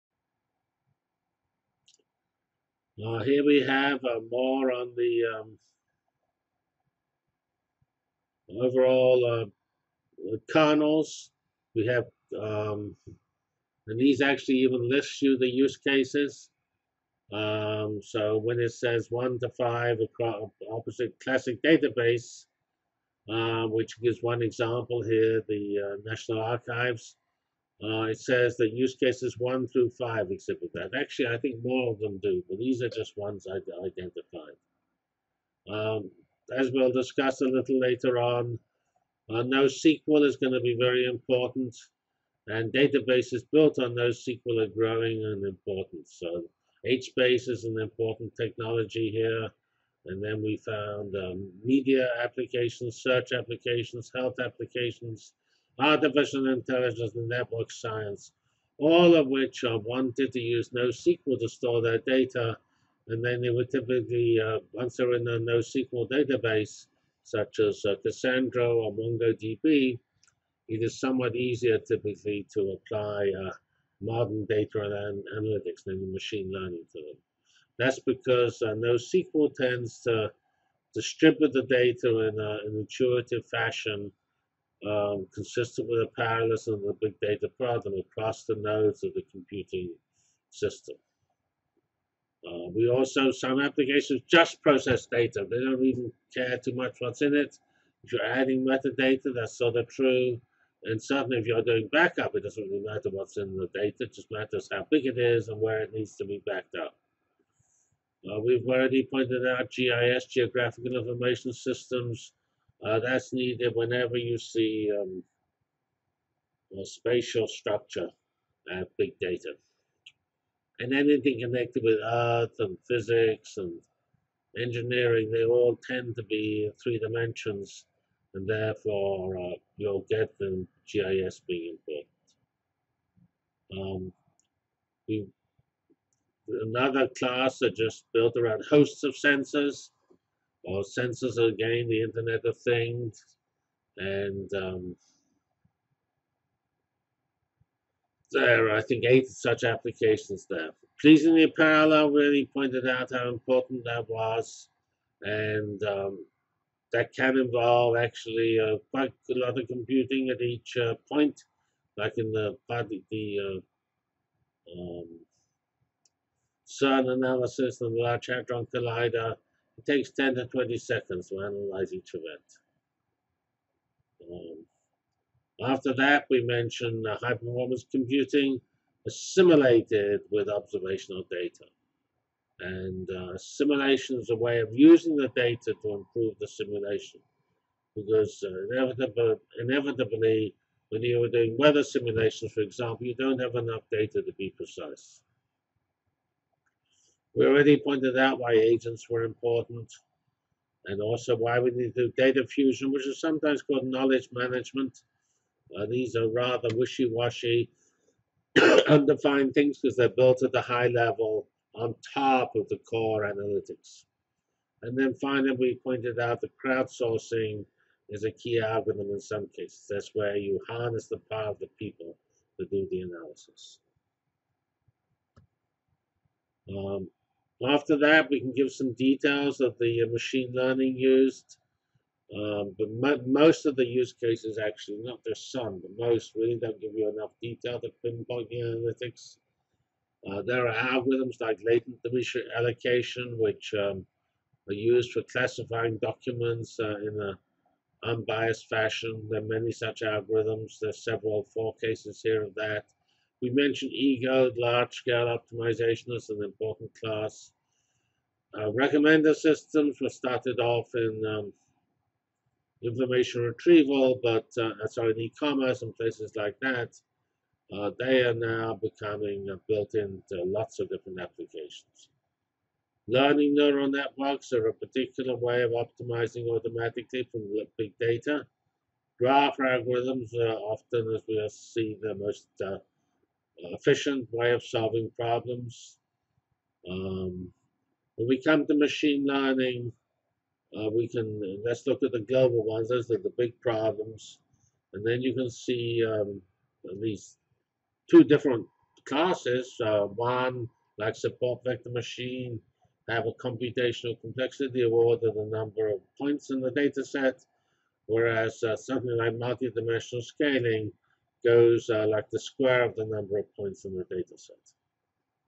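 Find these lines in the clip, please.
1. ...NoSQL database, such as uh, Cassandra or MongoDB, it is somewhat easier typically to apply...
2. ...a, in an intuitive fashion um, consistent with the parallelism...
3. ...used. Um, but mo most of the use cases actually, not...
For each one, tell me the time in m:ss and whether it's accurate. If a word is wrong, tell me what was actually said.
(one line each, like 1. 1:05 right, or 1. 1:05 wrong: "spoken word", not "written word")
1. 1:05 right
2. 1:22 right
3. 3:50 right.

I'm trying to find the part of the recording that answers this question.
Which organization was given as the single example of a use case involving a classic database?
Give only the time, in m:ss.
0:26.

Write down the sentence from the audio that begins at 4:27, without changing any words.
Uh, they are now becoming uh, built into lots of different applications.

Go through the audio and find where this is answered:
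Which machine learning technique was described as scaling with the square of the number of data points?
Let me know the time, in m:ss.
5:09.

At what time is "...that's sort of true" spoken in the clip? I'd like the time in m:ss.
1:39.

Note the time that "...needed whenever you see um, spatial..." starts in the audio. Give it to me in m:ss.
1:53.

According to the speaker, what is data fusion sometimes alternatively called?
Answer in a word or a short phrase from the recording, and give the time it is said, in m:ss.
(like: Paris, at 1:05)
knowledge management, at 3:23.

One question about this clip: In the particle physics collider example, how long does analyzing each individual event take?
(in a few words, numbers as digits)
10 to 20 seconds.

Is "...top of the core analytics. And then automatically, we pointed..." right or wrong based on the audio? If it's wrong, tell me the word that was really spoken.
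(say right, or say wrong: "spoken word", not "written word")
wrong: "finally", not "automatically".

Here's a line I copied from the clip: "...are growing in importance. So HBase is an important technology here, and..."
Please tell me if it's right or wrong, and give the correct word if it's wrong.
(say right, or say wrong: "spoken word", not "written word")
right.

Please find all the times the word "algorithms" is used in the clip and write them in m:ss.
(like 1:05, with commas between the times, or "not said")
3:38, 4:00, 4:10, 4:39.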